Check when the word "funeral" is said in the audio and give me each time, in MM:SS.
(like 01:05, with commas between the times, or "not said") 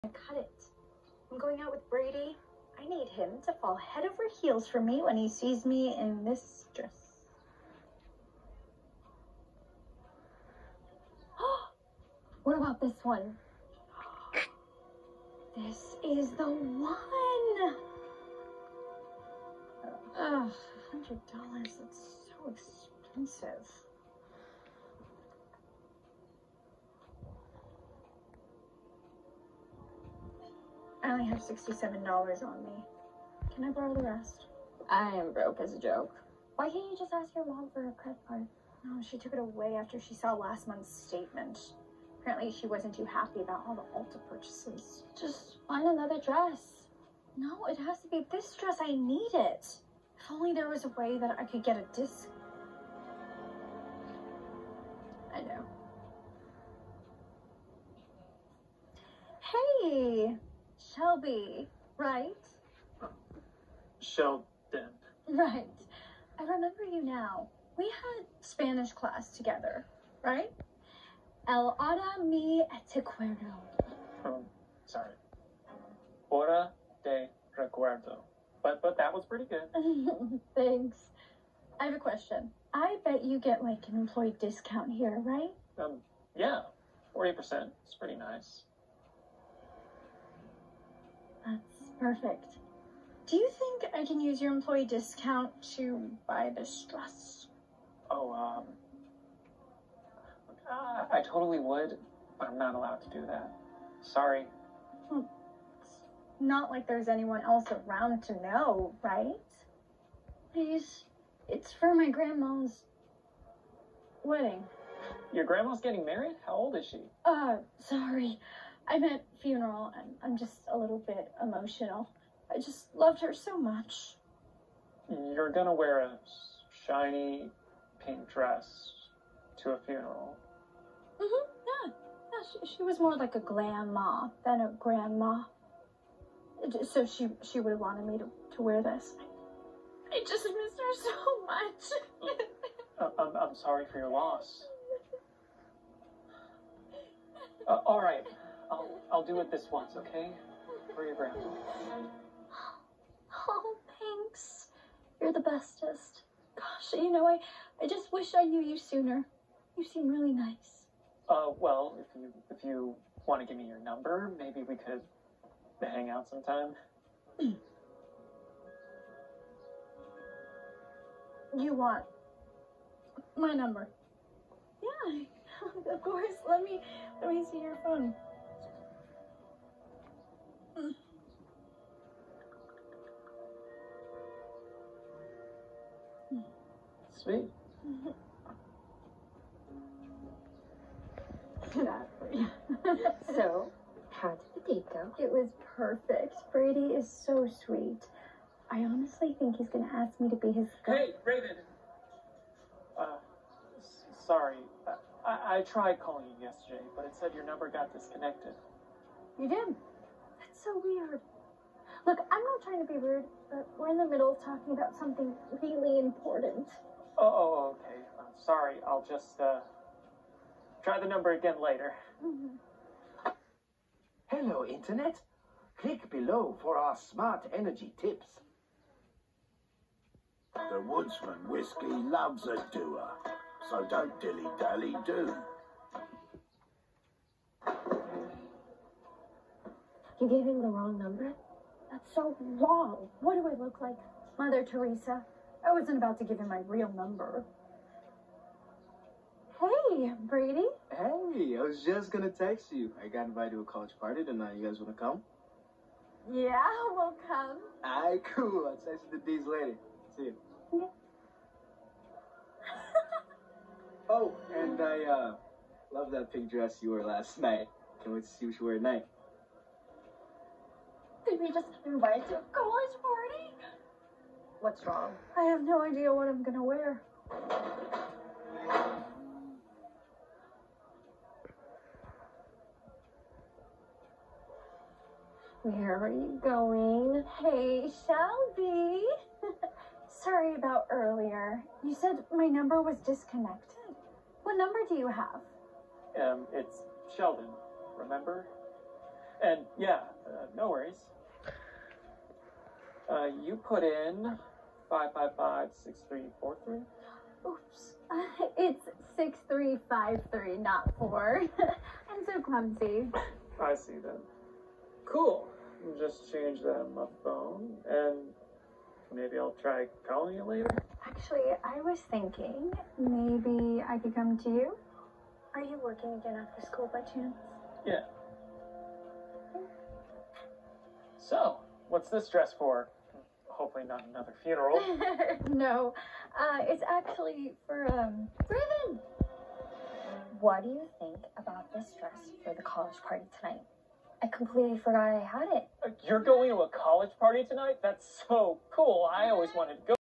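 01:59, 02:09, 05:34.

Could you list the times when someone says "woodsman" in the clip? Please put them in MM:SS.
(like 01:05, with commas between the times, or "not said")
03:50.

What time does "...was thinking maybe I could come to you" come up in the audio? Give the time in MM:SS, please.
05:21.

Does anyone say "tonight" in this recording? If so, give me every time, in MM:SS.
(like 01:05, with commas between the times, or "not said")
04:14, 04:28, 05:43, 05:47.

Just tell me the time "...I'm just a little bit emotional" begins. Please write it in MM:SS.
02:00.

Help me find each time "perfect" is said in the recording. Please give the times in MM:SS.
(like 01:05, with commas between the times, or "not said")
01:31, 03:15.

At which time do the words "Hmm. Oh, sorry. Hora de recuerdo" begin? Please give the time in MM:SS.
01:14.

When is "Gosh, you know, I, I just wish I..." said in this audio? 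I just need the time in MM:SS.
02:36.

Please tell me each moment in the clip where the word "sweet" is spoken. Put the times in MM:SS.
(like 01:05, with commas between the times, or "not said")
03:07, 03:17.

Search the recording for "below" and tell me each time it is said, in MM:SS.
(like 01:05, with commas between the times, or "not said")
03:46.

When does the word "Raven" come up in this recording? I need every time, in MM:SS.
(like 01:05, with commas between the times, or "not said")
03:21, 05:38.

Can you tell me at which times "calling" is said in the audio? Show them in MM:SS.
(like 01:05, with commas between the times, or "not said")
03:25, 05:20.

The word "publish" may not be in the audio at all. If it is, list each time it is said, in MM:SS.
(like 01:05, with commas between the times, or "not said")
not said.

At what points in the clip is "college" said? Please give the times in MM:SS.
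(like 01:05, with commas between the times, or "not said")
04:13, 04:32, 05:42, 05:46.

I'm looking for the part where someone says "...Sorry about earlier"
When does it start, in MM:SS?
04:50.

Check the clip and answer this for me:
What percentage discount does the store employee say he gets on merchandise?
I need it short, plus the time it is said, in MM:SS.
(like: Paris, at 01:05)
40%, at 01:27.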